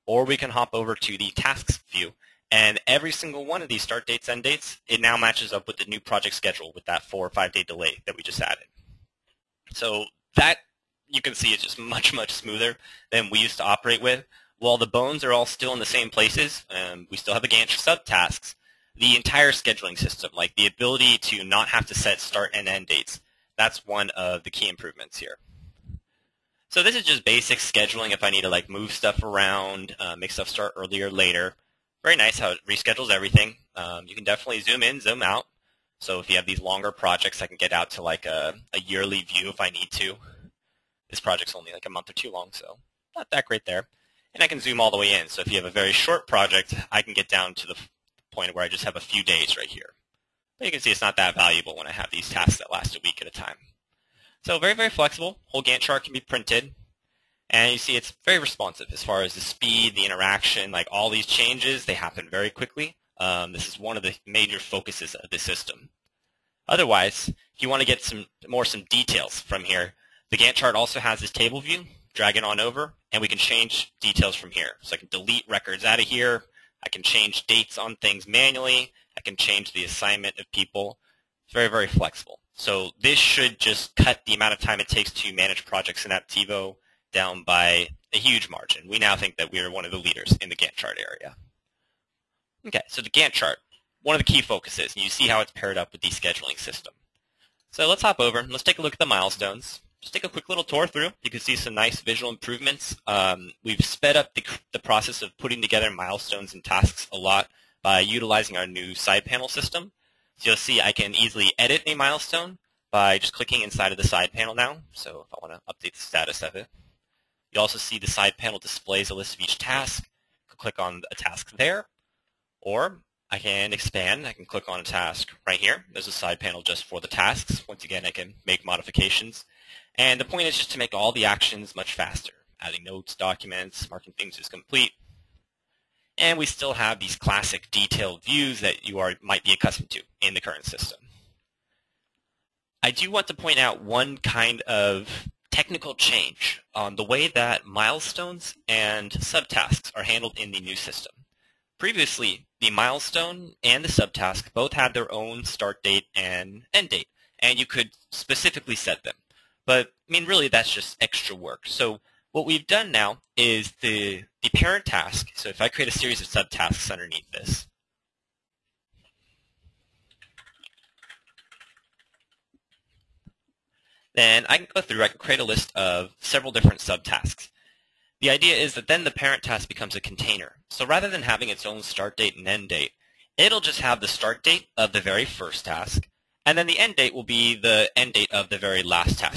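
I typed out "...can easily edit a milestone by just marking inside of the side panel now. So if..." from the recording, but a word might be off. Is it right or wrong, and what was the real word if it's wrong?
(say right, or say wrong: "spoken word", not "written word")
wrong: "clicking", not "marking".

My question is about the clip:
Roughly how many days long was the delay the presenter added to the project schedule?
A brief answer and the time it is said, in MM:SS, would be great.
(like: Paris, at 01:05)
4 or 5 days, at 00:07.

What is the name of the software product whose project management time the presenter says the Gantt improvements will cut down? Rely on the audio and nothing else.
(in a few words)
Apptivo.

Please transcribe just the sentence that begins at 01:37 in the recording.
So let's hop over and let's take a look at the milestones.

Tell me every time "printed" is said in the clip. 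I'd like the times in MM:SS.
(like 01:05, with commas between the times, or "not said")
00:56.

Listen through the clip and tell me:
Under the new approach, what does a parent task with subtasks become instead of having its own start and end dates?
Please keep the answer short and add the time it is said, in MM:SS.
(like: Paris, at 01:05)
a container, at 03:00.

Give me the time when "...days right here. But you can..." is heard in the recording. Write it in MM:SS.
00:49.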